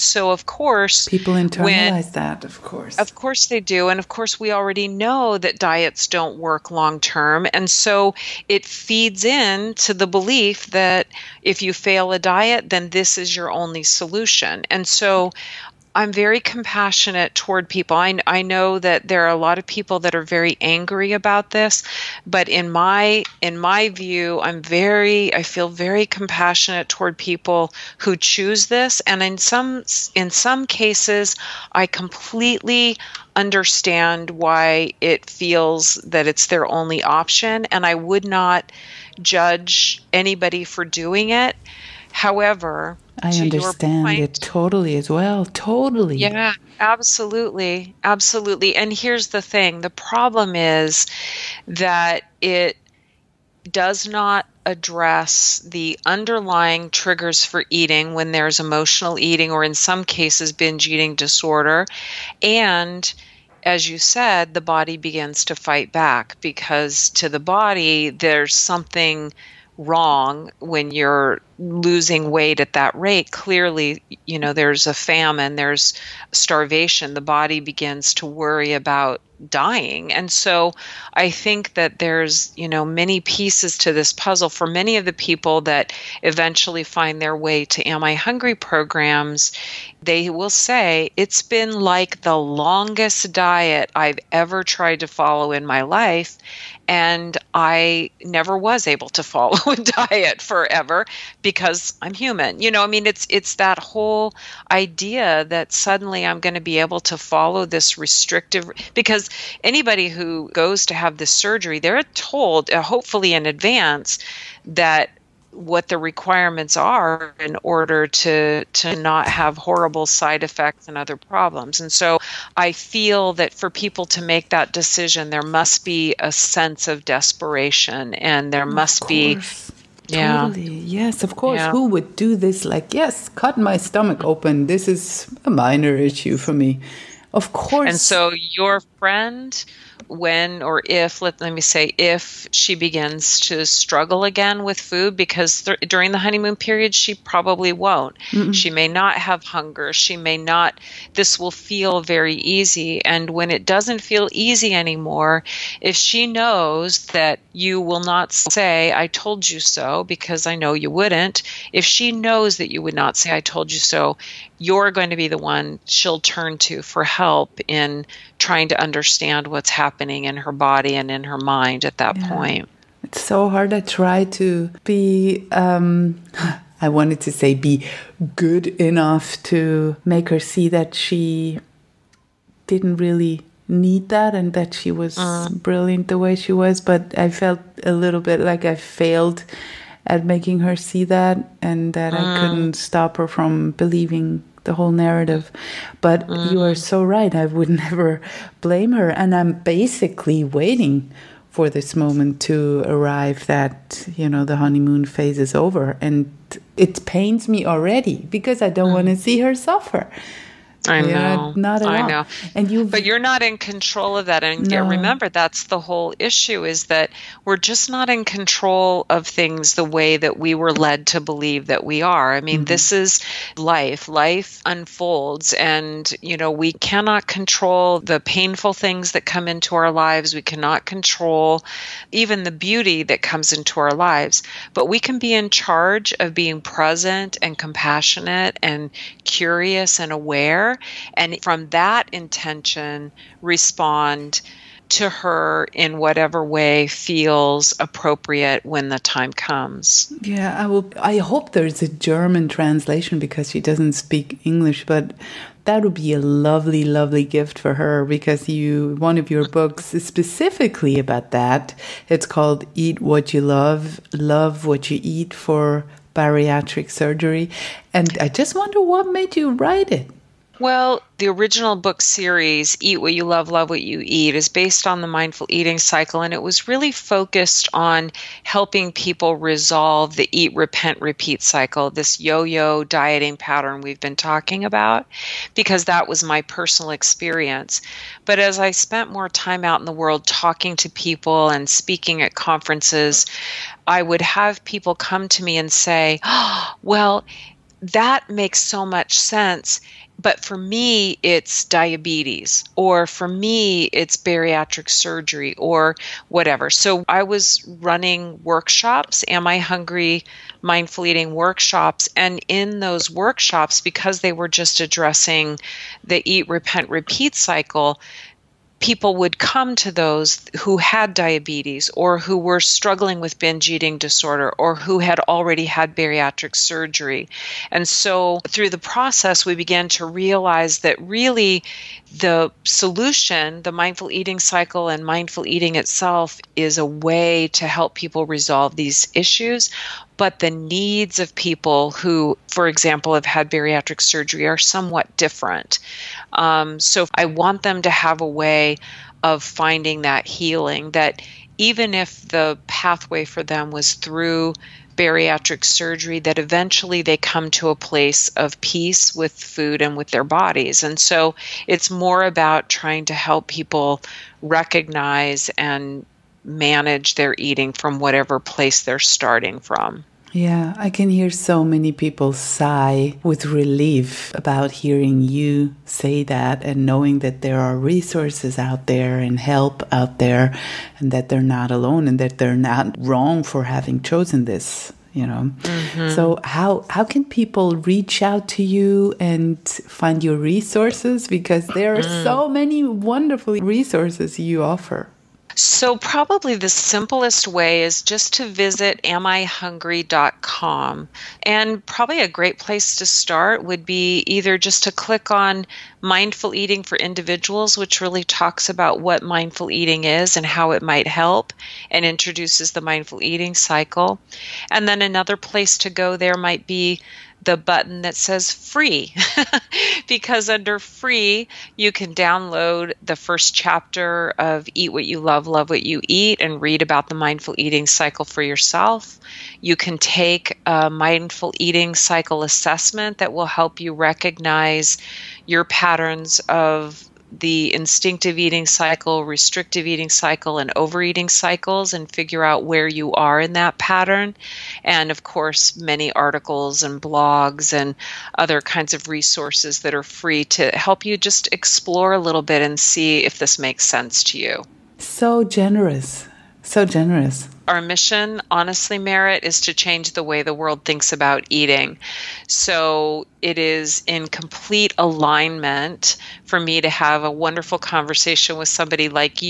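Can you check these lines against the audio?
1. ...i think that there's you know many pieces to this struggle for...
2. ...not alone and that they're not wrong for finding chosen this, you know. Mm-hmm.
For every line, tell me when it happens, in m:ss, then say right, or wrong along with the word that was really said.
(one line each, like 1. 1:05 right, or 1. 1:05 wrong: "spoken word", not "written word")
1. 1:21 wrong: "puzzle", not "struggle"
2. 6:21 wrong: "having", not "finding".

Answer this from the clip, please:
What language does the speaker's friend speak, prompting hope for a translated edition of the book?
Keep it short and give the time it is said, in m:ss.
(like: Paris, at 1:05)
German, at 4:11.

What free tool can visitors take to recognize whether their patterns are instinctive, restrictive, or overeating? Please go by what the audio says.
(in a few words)
mindful eating cycle assessment.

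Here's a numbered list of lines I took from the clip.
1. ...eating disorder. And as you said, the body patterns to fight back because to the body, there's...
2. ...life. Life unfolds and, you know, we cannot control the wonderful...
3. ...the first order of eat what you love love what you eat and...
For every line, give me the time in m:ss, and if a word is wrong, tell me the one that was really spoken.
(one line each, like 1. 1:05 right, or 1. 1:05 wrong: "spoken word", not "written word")
1. 1:00 wrong: "begins", not "patterns"
2. 3:43 wrong: "painful", not "wonderful"
3. 7:03 wrong: "chapter", not "order".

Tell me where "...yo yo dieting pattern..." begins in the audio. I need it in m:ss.
4:42.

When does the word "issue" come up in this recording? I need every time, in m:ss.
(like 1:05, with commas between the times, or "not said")
2:15, 3:36, 5:39.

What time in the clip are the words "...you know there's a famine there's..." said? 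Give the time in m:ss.
1:14.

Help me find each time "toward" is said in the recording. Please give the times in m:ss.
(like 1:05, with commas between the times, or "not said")
0:17, 0:26.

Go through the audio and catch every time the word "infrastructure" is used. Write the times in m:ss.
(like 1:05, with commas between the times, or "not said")
not said.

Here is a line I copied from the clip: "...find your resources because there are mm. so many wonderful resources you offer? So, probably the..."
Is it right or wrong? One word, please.
right.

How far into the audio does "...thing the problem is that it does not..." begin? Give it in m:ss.
0:49.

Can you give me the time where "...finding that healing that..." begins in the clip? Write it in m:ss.
5:49.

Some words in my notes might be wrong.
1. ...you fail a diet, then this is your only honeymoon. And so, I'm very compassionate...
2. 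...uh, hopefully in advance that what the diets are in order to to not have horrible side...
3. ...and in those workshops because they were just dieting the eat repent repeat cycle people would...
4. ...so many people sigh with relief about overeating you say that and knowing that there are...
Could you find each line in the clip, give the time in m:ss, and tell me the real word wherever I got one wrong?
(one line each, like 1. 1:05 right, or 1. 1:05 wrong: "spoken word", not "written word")
1. 0:11 wrong: "solution", not "honeymoon"
2. 1:52 wrong: "requirements", not "diets"
3. 5:12 wrong: "addressing", not "dieting"
4. 6:11 wrong: "hearing", not "overeating".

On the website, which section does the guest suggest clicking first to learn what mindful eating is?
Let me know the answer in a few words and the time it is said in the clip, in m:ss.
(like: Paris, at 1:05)
Mindful Eating for Individuals, at 6:46.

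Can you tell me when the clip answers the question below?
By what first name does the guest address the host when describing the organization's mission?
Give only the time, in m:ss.
7:38.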